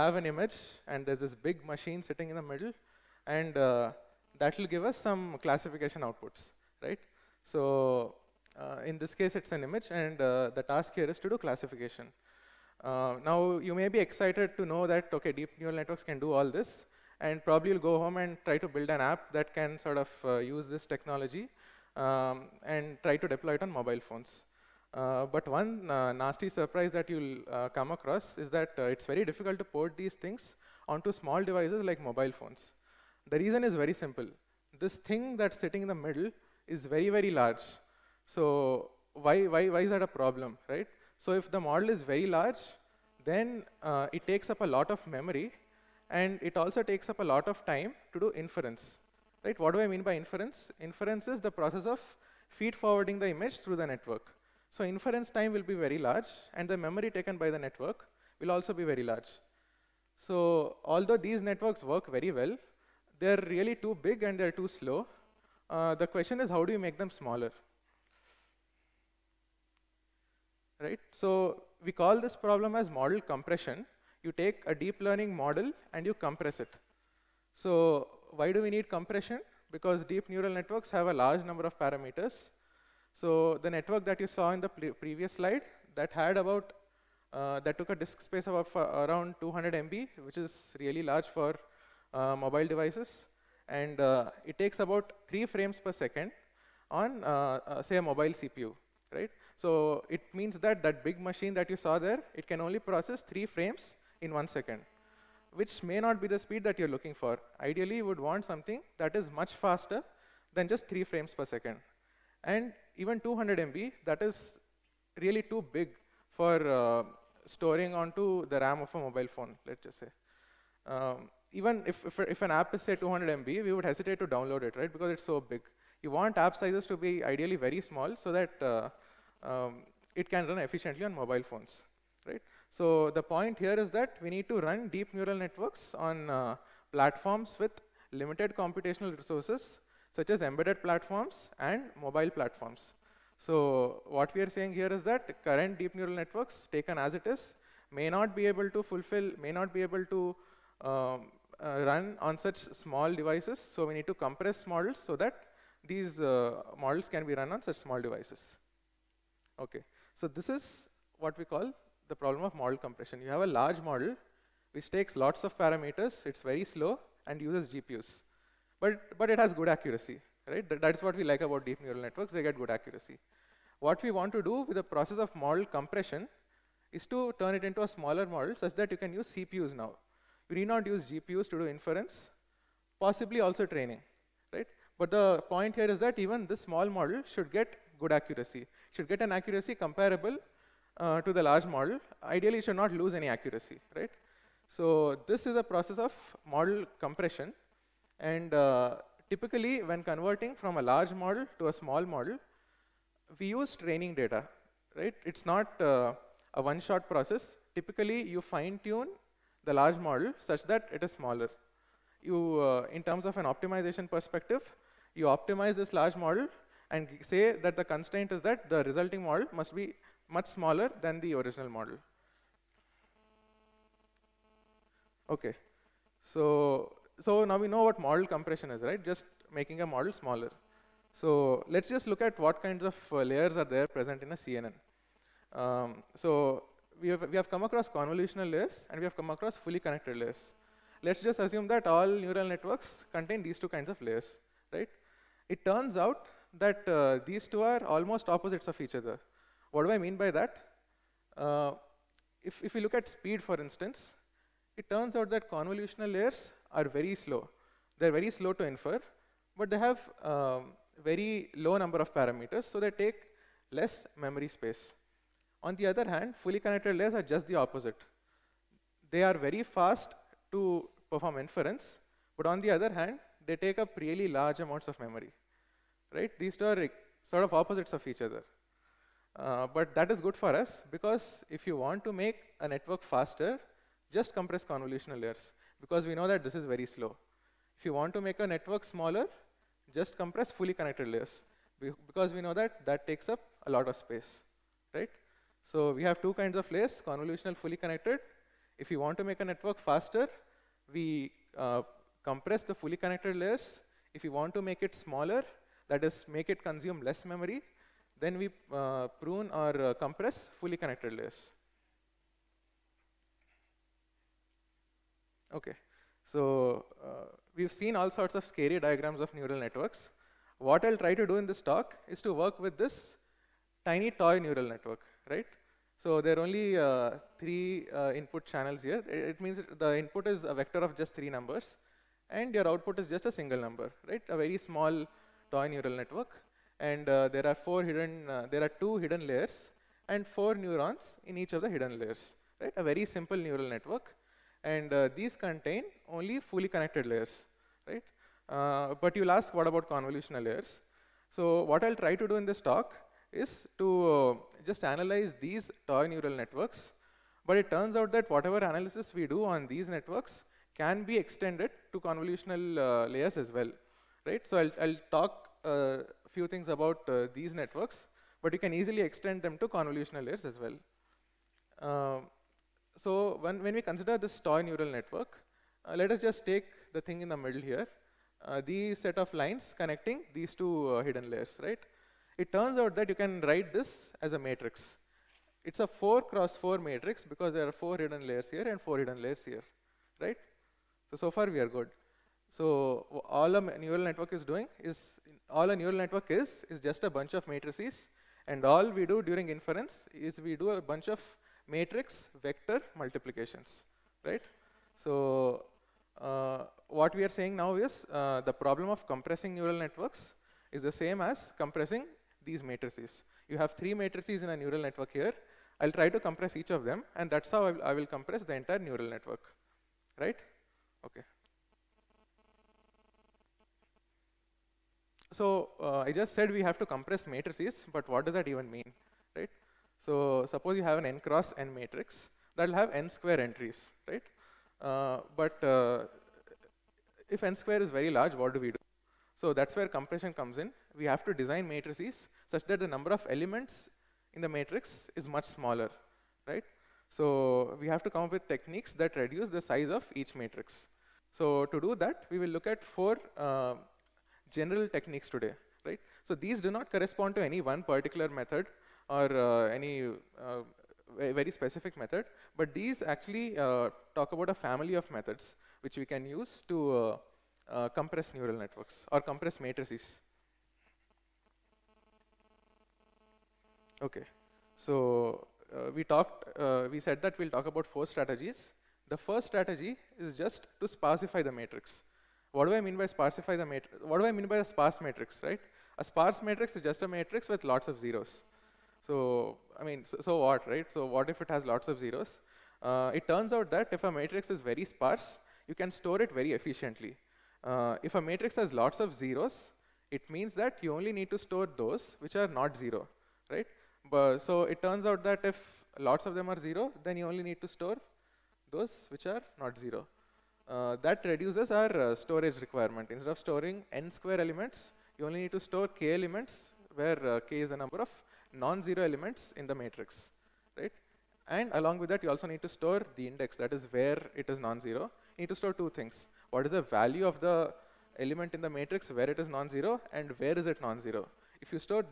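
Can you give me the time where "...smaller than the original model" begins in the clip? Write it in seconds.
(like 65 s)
220 s.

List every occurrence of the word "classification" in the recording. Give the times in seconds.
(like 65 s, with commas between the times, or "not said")
5 s, 11 s.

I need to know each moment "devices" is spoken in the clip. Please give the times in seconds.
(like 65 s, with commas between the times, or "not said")
31 s, 92 s, 153 s, 158 s.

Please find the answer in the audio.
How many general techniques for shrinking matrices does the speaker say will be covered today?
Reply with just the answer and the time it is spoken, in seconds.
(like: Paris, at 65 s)
4, at 452 s.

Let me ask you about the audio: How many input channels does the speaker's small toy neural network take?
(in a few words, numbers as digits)
3.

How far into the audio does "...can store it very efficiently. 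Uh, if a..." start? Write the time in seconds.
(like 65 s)
495 s.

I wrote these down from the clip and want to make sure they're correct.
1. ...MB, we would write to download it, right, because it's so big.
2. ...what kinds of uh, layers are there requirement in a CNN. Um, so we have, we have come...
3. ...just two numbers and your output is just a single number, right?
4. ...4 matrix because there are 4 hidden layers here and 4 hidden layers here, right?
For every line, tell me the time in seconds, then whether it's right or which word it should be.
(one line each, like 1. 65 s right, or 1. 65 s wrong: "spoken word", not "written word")
1. 123 s wrong: "hesitate", not "write"
2. 232 s wrong: "present", not "requirement"
3. 330 s wrong: "three", not "two"
4. 386 s right.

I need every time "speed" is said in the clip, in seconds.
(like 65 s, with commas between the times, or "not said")
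106 s, 253 s.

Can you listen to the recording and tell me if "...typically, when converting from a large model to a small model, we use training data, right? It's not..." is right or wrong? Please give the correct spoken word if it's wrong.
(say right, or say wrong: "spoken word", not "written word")
right.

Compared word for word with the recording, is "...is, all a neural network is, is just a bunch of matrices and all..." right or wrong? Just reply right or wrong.
right.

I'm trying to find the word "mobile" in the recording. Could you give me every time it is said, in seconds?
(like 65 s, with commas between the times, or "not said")
23 s, 32 s, 92 s, 98 s, 118 s, 131 s, 142 s.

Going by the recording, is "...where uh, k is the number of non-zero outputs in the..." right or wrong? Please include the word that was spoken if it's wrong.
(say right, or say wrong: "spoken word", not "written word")
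wrong: "elements", not "outputs".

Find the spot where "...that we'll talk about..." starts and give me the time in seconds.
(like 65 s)
477 s.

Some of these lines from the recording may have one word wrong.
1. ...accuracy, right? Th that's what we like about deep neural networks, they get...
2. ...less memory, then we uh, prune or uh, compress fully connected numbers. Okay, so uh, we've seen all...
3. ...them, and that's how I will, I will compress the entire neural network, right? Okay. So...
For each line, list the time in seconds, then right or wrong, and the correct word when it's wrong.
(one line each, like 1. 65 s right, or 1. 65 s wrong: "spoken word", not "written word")
1. 169 s right
2. 307 s wrong: "layers", not "numbers"
3. 416 s right.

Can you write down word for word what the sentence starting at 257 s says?
They're very slow to infer, but they have um, very low number of parameters, so they take less memory space.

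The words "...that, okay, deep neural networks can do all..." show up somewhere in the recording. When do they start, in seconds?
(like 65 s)
14 s.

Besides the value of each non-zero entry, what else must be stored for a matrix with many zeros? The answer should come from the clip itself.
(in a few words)
the index.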